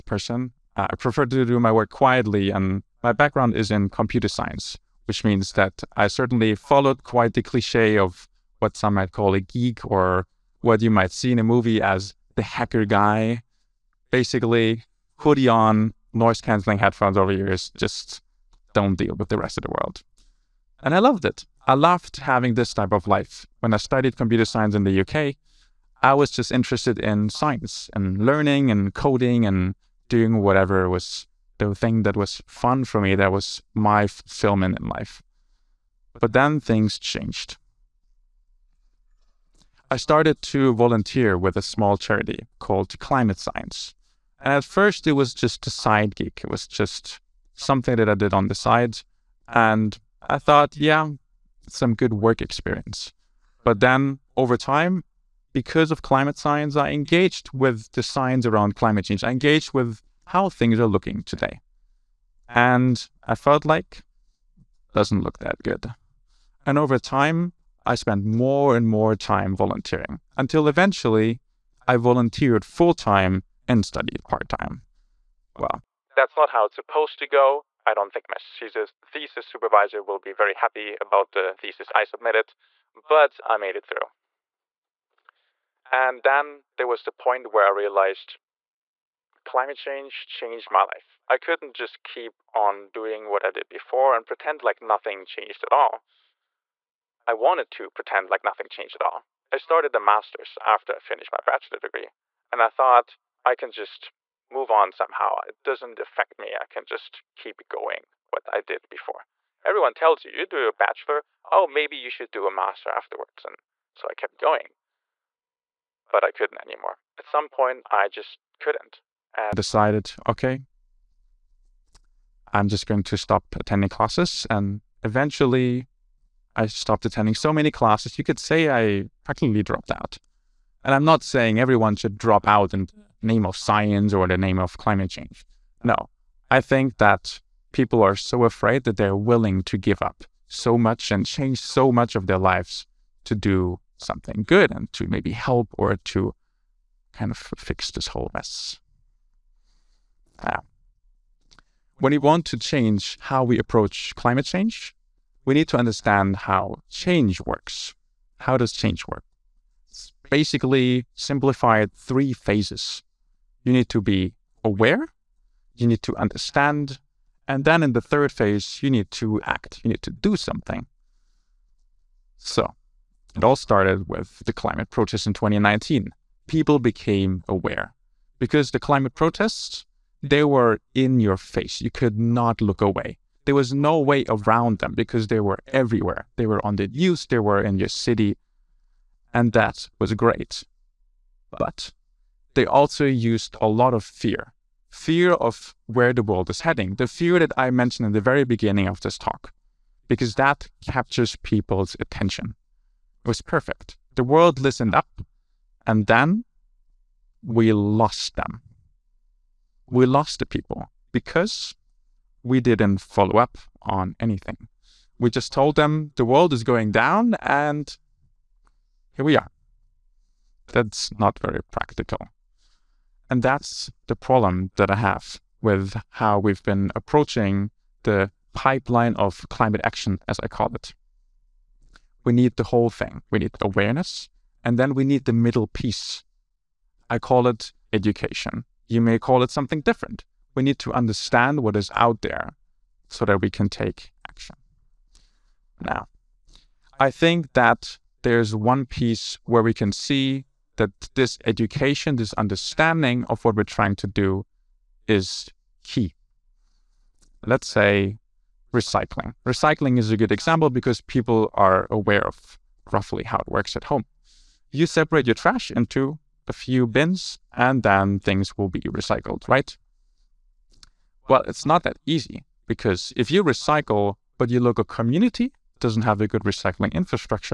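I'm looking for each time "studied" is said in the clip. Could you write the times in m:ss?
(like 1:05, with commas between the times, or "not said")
0:23, 1:13.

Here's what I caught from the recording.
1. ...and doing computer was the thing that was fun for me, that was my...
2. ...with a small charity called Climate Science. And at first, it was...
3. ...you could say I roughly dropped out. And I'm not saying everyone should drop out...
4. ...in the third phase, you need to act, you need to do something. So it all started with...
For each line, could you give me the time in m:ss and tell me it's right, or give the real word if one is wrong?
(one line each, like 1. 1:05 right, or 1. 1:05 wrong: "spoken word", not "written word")
1. 0:29 wrong: "whatever", not "computer"
2. 0:41 right
3. 2:08 wrong: "practically", not "roughly"
4. 2:47 right.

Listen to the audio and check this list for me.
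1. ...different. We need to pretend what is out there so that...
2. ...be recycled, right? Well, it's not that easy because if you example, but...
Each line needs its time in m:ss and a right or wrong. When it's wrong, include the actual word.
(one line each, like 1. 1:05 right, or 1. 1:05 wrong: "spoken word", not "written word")
1. 3:59 wrong: "understand", not "pretend"
2. 4:28 wrong: "recycle", not "example".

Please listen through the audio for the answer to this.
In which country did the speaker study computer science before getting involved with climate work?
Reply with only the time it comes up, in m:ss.
0:25.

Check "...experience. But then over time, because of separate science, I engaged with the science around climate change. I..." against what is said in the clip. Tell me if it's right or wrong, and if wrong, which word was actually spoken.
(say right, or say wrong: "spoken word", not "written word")
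wrong: "climate", not "separate".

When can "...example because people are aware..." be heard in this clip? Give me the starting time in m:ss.
4:20.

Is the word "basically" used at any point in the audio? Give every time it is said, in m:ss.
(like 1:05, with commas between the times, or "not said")
0:14, 2:40.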